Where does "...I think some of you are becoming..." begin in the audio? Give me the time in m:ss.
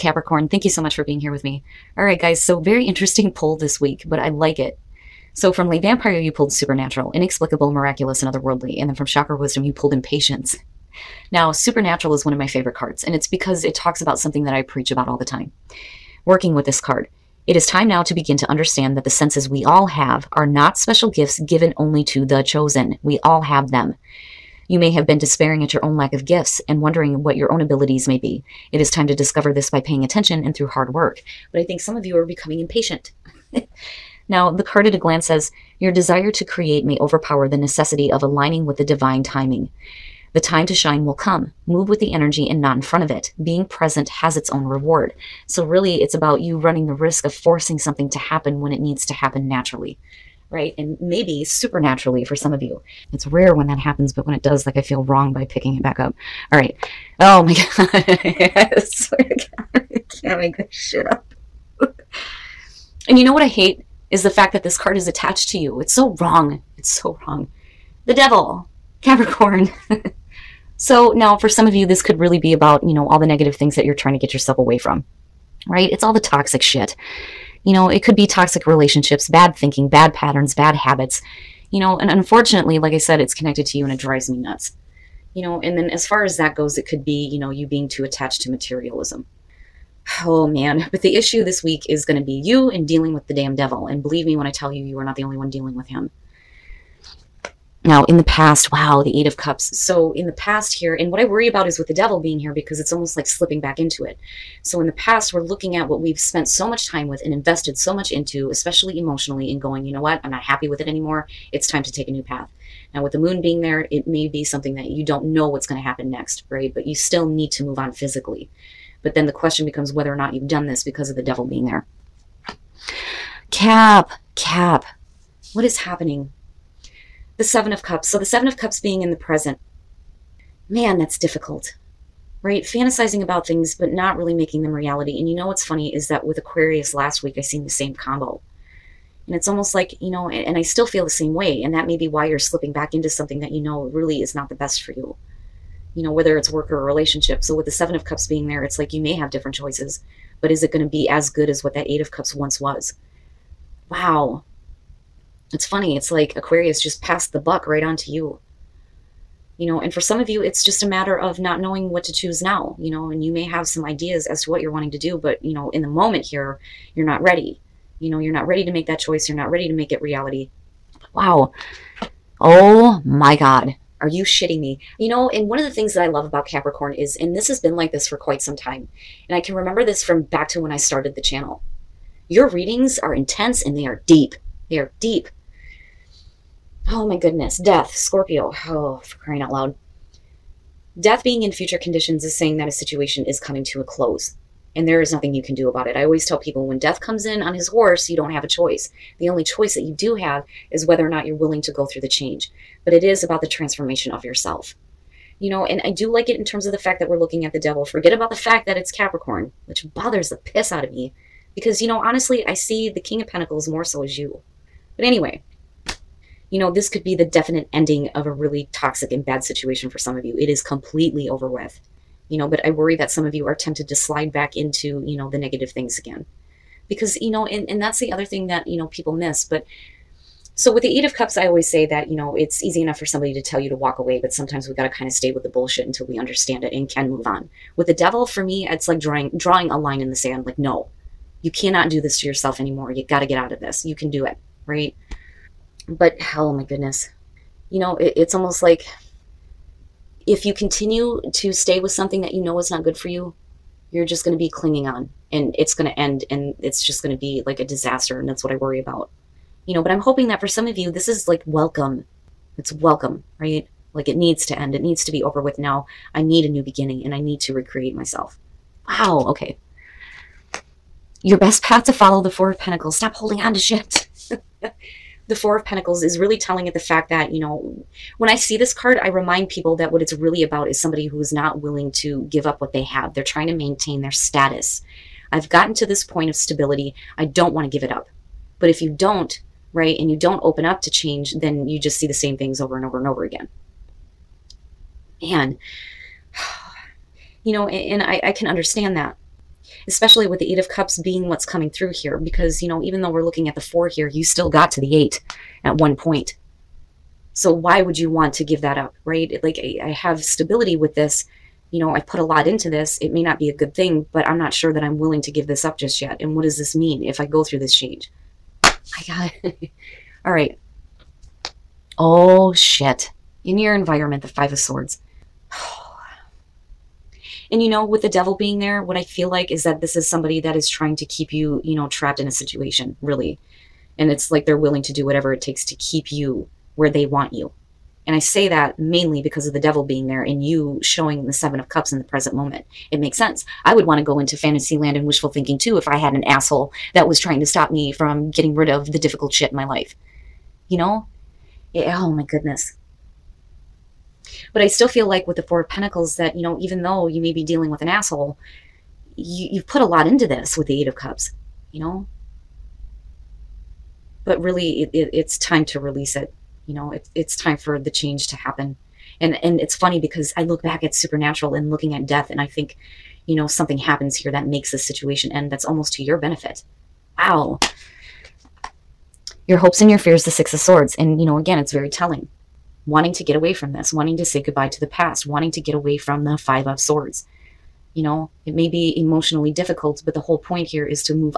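0:31.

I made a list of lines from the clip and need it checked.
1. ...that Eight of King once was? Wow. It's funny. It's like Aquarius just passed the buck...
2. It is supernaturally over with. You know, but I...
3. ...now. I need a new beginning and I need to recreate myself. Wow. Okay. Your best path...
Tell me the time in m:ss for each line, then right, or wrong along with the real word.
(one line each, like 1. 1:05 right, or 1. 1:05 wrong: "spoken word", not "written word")
1. 2:31 wrong: "Cups", not "King"
2. 3:40 wrong: "completely", not "supernaturally"
3. 4:25 right.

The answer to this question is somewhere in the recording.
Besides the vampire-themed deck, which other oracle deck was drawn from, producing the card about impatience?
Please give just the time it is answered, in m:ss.
0:09.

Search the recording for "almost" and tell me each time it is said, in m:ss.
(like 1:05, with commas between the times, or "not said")
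1:42, 2:19, 4:08, 6:15.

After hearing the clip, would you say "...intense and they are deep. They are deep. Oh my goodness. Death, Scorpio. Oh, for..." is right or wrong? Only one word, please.
right.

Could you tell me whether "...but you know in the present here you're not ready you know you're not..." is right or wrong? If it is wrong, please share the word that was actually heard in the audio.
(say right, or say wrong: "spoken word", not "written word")
wrong: "moment", not "present".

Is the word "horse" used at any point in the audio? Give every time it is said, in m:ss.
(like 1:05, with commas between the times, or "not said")
3:17.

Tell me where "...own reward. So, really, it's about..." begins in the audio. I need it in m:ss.
0:44.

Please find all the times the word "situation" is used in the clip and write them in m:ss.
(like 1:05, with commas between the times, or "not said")
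3:12, 3:39, 5:32, 6:14.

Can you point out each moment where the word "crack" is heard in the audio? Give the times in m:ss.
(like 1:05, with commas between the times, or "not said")
not said.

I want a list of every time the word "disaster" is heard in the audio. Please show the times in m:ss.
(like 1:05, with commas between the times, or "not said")
4:17.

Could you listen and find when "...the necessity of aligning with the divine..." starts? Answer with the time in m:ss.
0:37.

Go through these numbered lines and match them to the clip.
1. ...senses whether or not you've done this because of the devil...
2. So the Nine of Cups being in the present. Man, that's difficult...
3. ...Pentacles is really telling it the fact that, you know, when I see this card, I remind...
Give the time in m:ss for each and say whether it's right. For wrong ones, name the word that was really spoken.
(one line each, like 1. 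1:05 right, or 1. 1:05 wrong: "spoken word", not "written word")
1. 1:59 wrong: "becomes", not "senses"
2. 2:08 wrong: "Seven", not "Nine"
3. 4:35 right.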